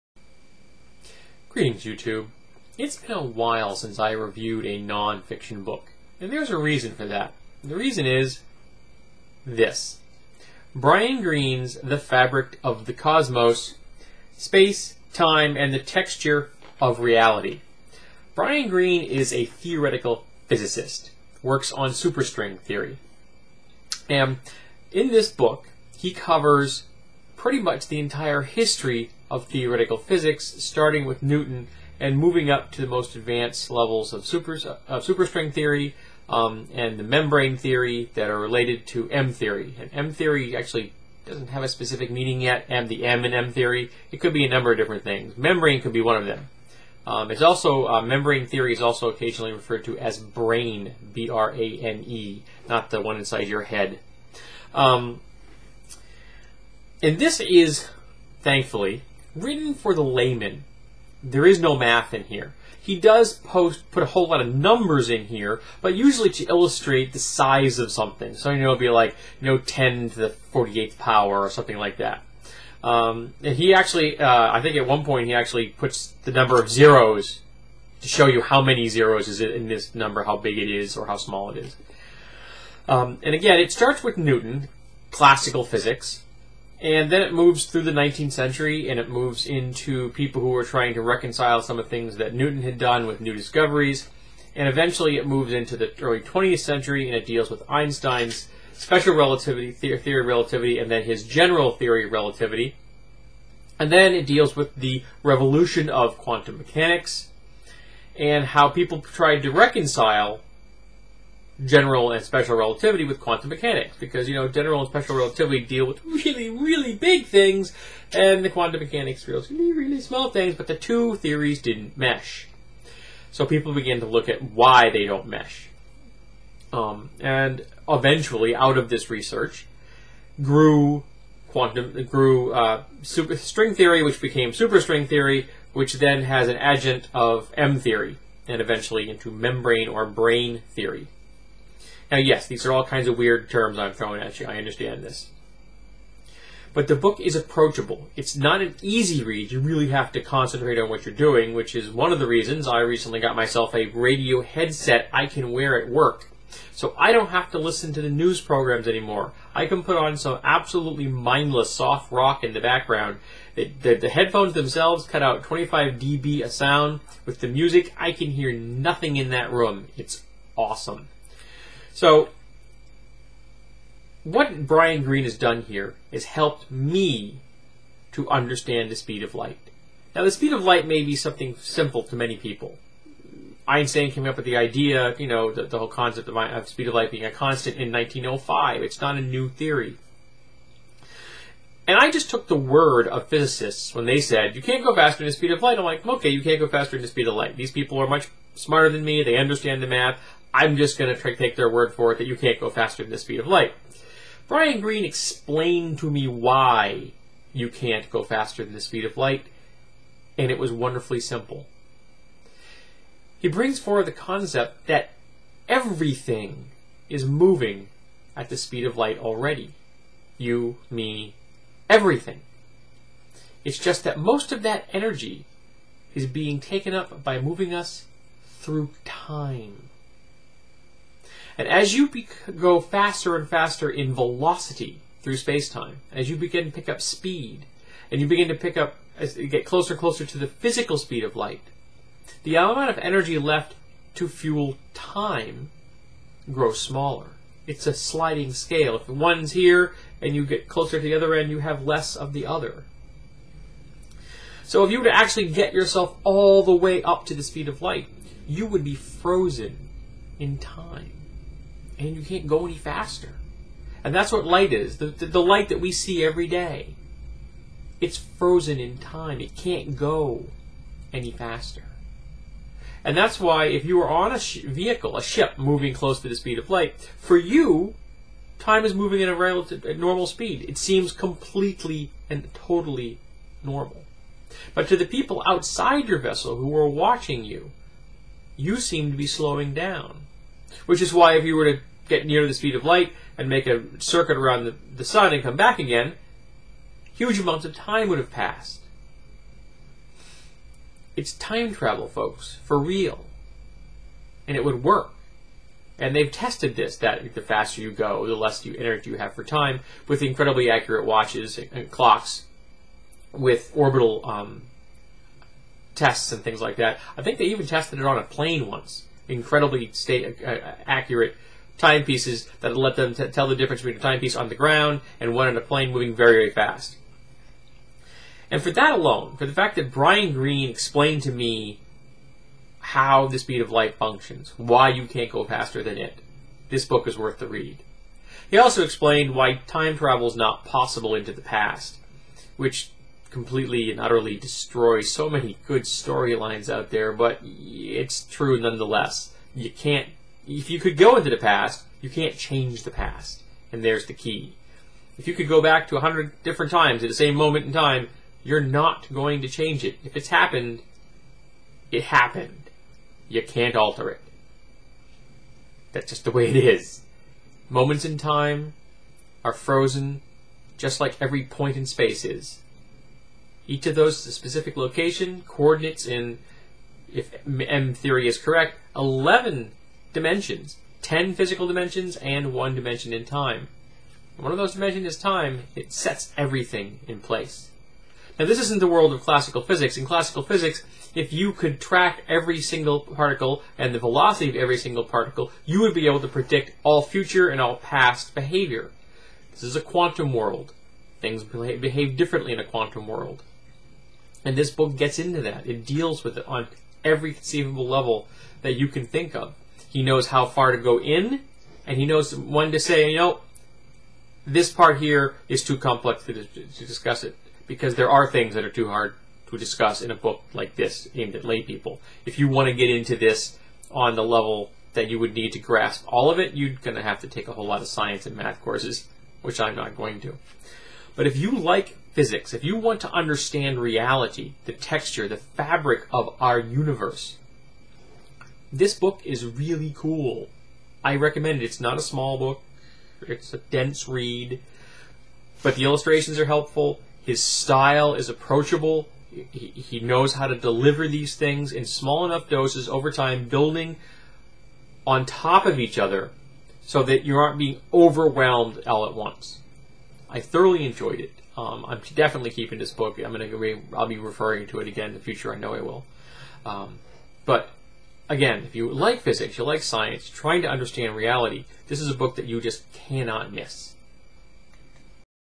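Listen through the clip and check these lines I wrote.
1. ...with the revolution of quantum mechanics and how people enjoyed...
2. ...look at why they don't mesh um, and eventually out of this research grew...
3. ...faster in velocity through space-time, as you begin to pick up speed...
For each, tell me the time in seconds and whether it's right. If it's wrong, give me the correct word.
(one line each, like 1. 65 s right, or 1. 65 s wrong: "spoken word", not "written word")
1. 104 s wrong: "tried", not "enjoyed"
2. 124 s right
3. 233 s right.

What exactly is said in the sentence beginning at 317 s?
I think they even tested it on a plane once.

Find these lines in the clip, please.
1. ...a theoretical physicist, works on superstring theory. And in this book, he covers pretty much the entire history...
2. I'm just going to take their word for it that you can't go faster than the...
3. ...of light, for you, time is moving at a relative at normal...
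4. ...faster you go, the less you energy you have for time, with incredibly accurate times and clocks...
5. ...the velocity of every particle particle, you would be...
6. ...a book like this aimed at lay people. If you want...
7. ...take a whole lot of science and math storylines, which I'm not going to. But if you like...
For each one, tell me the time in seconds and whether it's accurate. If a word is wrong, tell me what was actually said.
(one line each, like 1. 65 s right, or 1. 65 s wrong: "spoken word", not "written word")
1. 19 s right
2. 200 s right
3. 276 s right
4. 307 s wrong: "watches", not "times"
5. 393 s wrong: "single", not "particle"
6. 420 s right
7. 427 s wrong: "courses", not "storylines".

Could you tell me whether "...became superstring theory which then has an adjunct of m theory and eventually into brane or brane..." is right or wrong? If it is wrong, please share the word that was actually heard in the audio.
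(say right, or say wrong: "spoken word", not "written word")
wrong: "membrane", not "brane".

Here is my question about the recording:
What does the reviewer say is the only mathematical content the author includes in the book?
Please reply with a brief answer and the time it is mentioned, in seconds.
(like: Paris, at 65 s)
Numbers, at 64 s.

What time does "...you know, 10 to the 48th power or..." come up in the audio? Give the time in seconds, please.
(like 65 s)
69 s.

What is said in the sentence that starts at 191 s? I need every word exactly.
And I just took the word of physicists when they said, you can't go faster than the speed of light.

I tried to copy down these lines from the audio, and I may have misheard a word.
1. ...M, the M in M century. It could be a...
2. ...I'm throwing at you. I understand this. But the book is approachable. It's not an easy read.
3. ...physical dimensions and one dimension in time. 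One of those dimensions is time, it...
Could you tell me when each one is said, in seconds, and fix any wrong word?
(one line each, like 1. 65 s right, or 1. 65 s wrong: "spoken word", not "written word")
1. 42 s wrong: "theory", not "century"
2. 143 s right
3. 381 s right.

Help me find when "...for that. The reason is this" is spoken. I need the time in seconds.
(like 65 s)
6 s.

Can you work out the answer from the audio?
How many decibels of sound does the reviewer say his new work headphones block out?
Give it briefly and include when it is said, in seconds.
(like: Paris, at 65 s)
25 dB, at 165 s.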